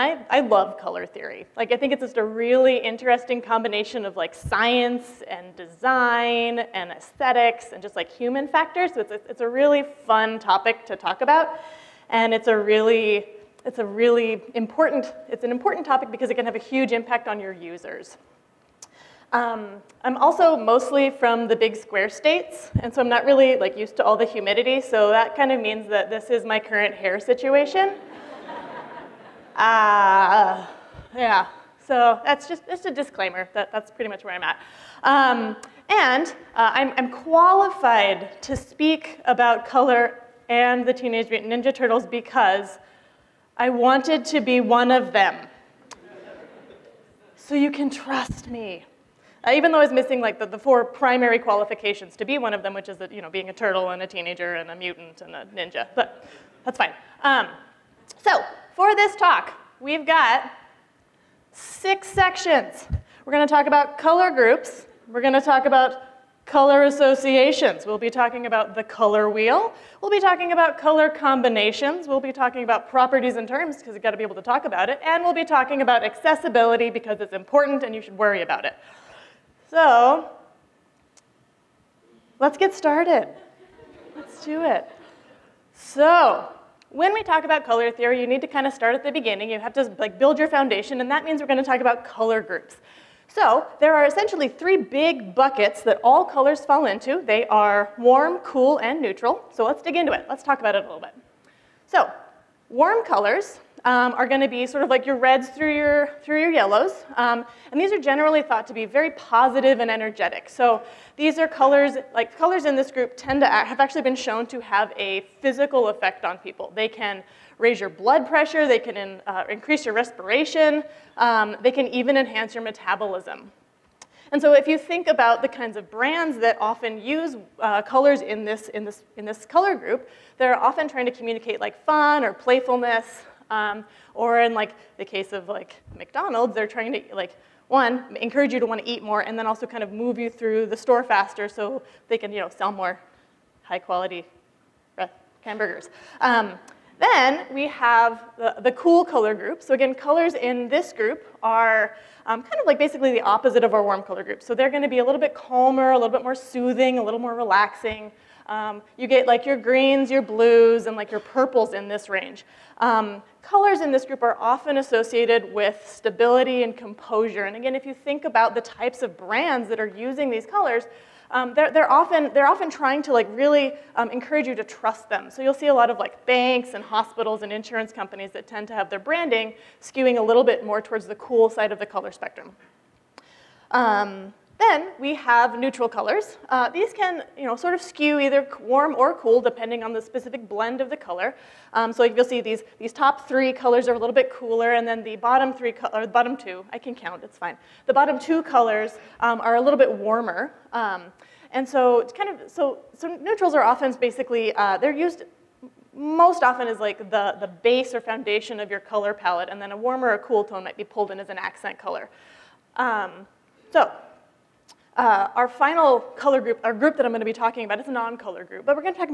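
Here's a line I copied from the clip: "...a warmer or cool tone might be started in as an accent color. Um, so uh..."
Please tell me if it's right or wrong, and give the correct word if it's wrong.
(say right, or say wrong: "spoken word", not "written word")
wrong: "pulled", not "started".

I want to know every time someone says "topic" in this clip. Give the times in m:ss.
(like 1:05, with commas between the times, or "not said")
0:10, 0:15.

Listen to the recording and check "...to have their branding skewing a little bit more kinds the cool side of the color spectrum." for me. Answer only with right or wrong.
wrong.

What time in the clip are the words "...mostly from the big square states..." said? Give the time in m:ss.
0:20.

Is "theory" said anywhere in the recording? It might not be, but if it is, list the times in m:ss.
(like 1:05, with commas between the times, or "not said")
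0:01, 1:27.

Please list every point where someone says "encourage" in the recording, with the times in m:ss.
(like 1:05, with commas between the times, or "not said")
2:18, 2:54.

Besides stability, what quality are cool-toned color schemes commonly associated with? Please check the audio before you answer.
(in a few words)
Composure.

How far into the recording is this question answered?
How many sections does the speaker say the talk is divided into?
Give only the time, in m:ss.
1:01.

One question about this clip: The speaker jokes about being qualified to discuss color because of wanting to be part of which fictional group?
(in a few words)
Teenage Mutant Ninja Turtles.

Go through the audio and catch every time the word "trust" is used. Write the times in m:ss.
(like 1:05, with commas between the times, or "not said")
0:47, 2:54.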